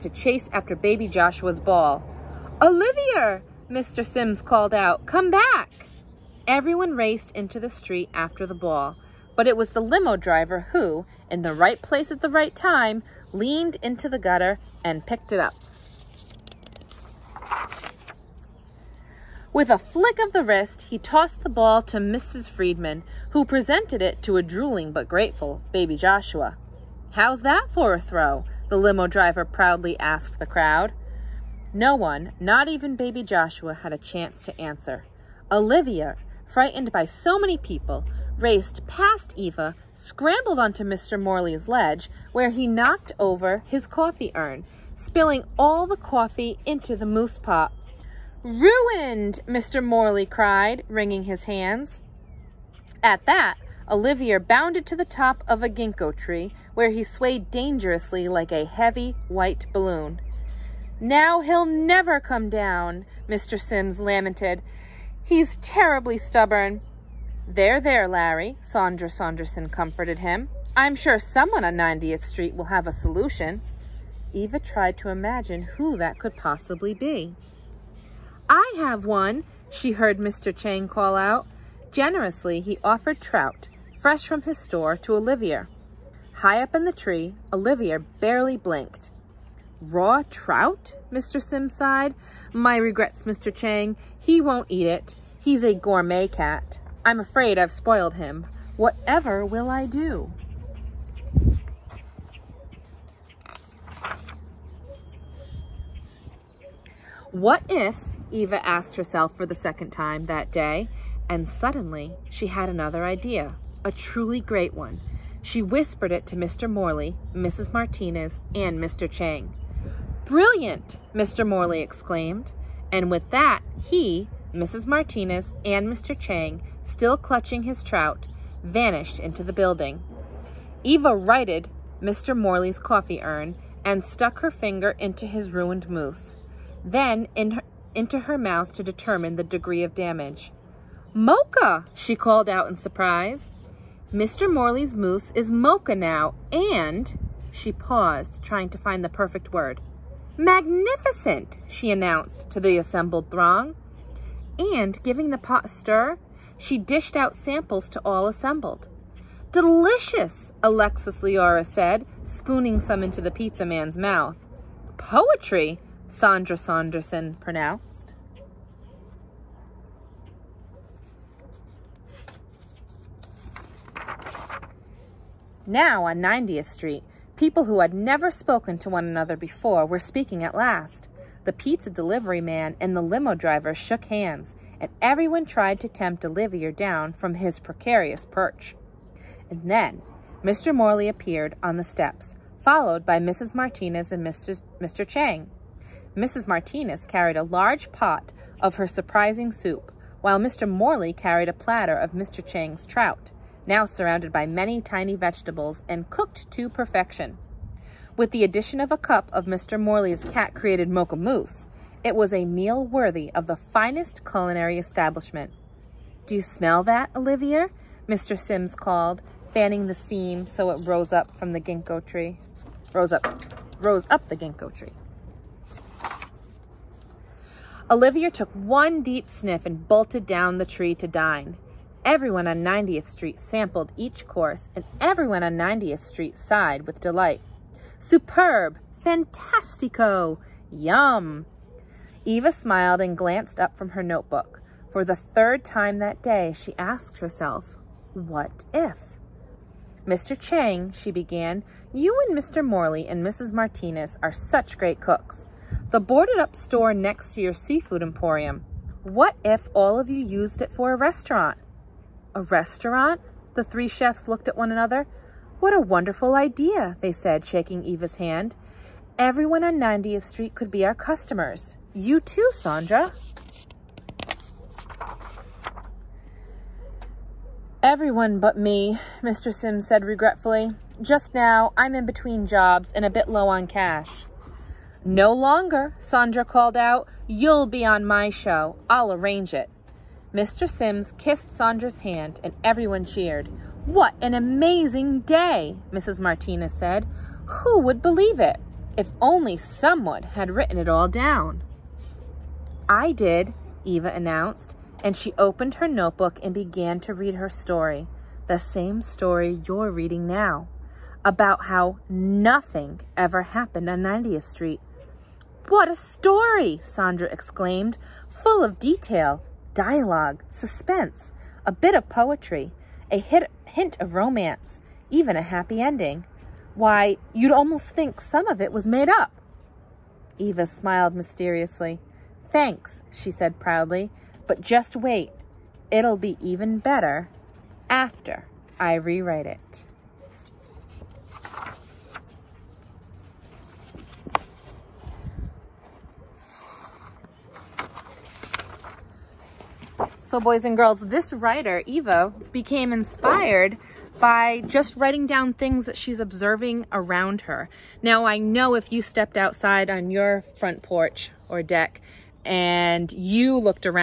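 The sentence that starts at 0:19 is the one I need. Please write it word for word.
With a flick of the wrist, he tossed the ball to Mrs.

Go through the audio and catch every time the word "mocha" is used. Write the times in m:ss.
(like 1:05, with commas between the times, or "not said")
2:21, 2:25, 3:30.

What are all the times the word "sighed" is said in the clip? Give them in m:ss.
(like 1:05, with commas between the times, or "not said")
1:31, 3:56.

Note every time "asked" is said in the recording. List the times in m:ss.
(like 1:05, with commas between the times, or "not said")
0:29, 1:48, 4:06.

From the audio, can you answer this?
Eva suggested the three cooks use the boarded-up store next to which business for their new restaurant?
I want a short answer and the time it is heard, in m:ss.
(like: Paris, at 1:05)
Seafood emporium, at 4:17.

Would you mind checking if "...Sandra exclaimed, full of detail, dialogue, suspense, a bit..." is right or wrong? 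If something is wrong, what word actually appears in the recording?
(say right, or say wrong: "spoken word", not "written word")
right.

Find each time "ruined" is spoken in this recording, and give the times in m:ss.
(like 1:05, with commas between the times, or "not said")
0:48, 2:15.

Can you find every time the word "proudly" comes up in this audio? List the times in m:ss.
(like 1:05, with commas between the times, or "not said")
0:29, 5:33.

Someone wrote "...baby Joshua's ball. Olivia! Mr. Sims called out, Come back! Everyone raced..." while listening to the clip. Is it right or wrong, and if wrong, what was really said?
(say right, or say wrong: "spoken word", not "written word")
right.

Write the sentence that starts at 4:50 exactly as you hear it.
Sims kissed Sandra's hand and everyone cheered.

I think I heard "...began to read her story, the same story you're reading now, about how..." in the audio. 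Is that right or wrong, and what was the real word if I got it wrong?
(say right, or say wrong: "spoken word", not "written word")
right.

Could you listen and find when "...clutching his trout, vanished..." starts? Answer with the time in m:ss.
2:07.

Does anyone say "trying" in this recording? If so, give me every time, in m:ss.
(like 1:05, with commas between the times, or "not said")
2:28.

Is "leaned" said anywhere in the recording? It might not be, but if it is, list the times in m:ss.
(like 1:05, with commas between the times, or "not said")
0:13.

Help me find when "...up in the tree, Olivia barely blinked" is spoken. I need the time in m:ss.
1:26.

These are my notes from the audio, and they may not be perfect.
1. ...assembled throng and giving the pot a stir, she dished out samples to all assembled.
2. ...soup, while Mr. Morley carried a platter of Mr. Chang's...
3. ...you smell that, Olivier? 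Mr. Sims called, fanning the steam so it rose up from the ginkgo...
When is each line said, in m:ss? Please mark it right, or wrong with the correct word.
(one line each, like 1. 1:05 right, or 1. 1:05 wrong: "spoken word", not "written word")
1. 2:32 right
2. 3:19 right
3. 3:36 right.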